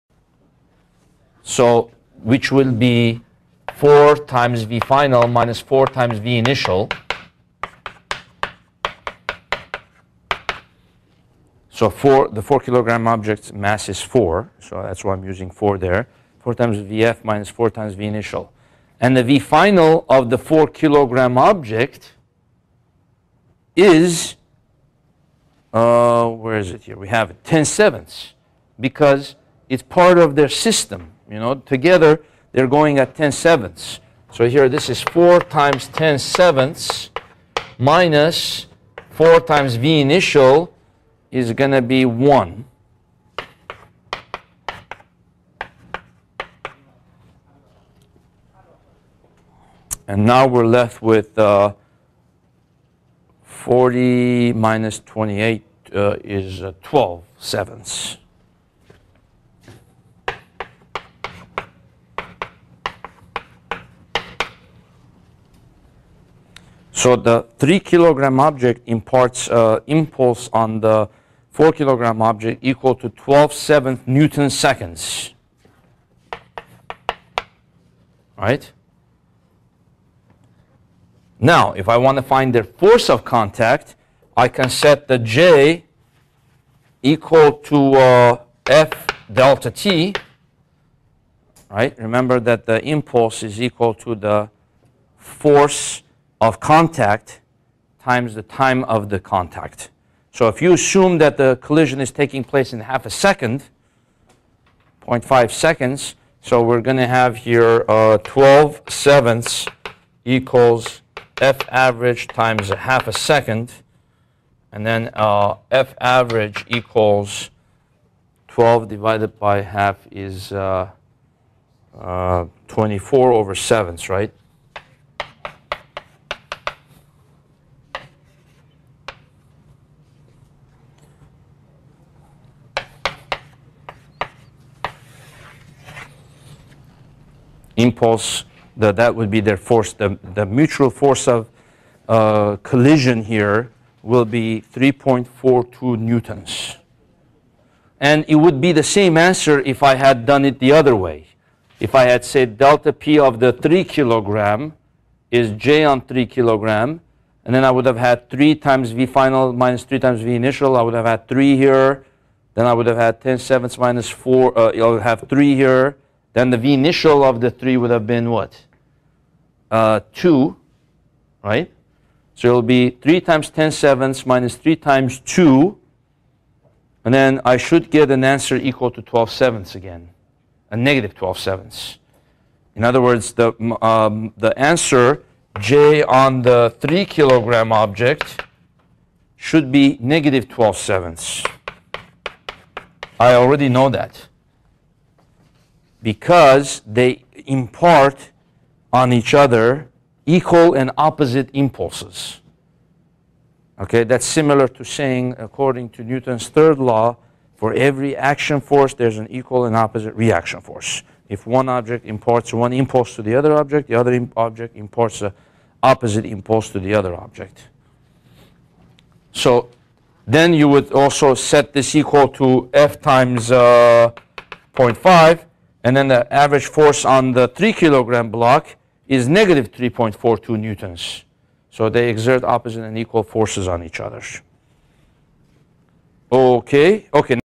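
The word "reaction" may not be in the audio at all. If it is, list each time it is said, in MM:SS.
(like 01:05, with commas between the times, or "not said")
03:30.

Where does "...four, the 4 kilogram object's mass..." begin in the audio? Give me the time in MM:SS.
00:11.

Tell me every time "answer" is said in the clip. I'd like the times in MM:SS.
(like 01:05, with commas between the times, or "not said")
02:29, 02:58, 03:04.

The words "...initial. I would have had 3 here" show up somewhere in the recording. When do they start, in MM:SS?
02:40.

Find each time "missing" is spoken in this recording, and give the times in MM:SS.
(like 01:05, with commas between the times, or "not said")
not said.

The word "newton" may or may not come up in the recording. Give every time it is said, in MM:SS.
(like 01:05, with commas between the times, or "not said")
01:14, 02:25, 03:26, 03:50.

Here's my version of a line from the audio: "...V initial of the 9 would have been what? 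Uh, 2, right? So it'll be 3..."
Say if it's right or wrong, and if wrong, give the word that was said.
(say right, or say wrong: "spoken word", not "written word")
wrong: "3", not "9".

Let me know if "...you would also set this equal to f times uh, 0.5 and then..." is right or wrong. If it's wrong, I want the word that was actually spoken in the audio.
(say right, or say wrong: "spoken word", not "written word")
right.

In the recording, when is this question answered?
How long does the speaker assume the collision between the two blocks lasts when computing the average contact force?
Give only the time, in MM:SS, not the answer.
01:45.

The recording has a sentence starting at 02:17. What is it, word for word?
impulse, the, that would be their force.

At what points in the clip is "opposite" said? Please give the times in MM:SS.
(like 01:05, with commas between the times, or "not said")
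03:20, 03:29, 03:35, 03:52.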